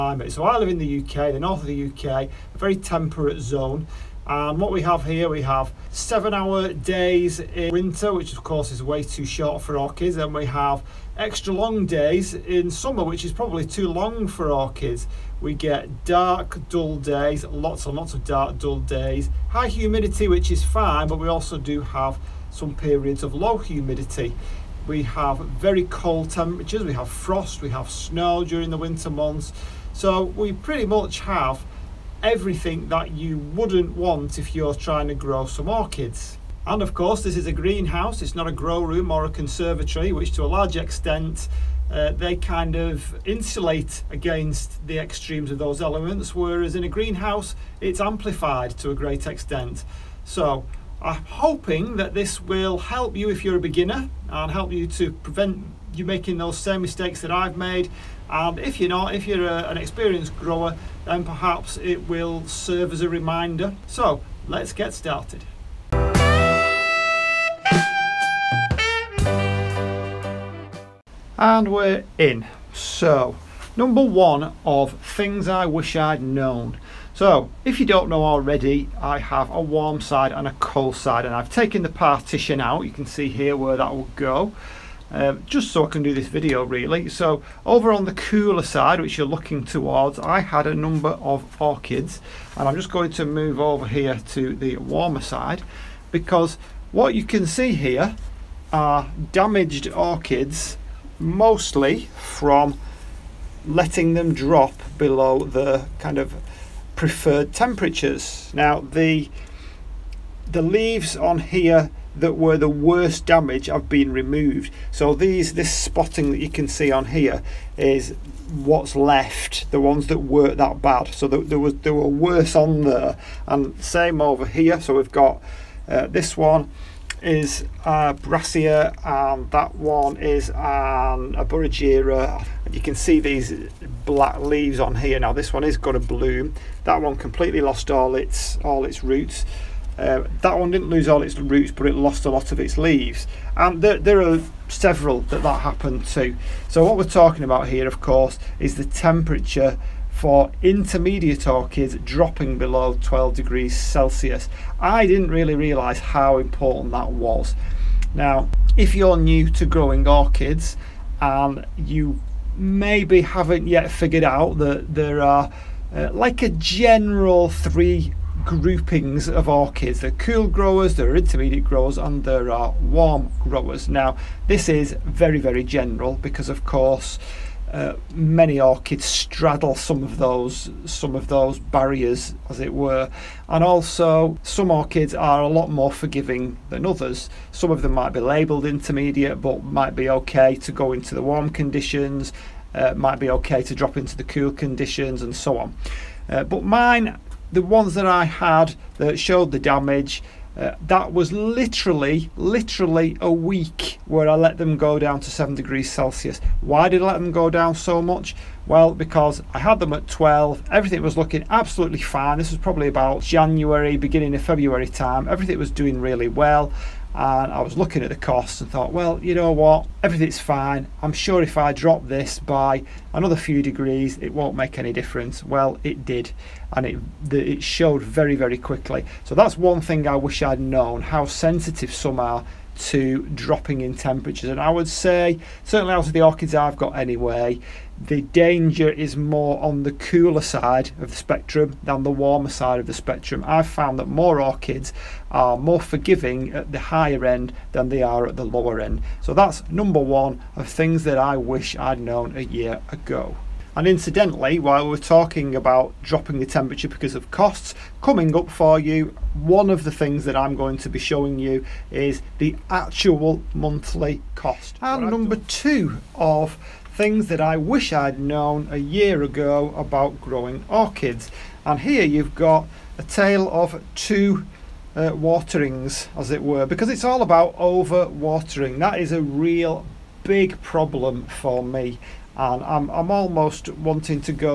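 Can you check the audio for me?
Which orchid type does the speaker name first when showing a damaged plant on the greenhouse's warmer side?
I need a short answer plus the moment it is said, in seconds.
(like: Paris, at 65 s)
Brassia, at 128 s.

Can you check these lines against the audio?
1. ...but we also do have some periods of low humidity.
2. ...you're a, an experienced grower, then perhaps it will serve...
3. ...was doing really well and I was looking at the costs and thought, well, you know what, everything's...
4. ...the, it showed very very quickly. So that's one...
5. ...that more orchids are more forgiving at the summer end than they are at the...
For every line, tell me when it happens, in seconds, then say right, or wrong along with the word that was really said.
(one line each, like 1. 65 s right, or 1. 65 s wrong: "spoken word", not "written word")
1. 21 s right
2. 59 s right
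3. 215 s right
4. 227 s right
5. 243 s wrong: "higher", not "summer".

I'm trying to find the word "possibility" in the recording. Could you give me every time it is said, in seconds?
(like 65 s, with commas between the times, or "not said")
not said.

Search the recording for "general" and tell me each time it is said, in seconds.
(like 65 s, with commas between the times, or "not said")
166 s, 175 s.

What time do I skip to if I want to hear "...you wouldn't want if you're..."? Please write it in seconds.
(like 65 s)
33 s.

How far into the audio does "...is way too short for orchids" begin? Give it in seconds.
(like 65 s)
8 s.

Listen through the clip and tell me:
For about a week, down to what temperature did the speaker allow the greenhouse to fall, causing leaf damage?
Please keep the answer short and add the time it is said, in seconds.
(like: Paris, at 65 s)
7 degrees Celsius, at 205 s.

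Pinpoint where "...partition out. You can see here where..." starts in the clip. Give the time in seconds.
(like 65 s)
81 s.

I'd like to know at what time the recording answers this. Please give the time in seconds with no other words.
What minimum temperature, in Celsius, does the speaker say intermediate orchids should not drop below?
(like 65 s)
153 s.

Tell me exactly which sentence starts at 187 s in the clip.
Some of them might be labelled intermediate, but might be okay to go into the warm conditions.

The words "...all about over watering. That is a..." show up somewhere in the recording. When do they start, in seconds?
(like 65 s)
277 s.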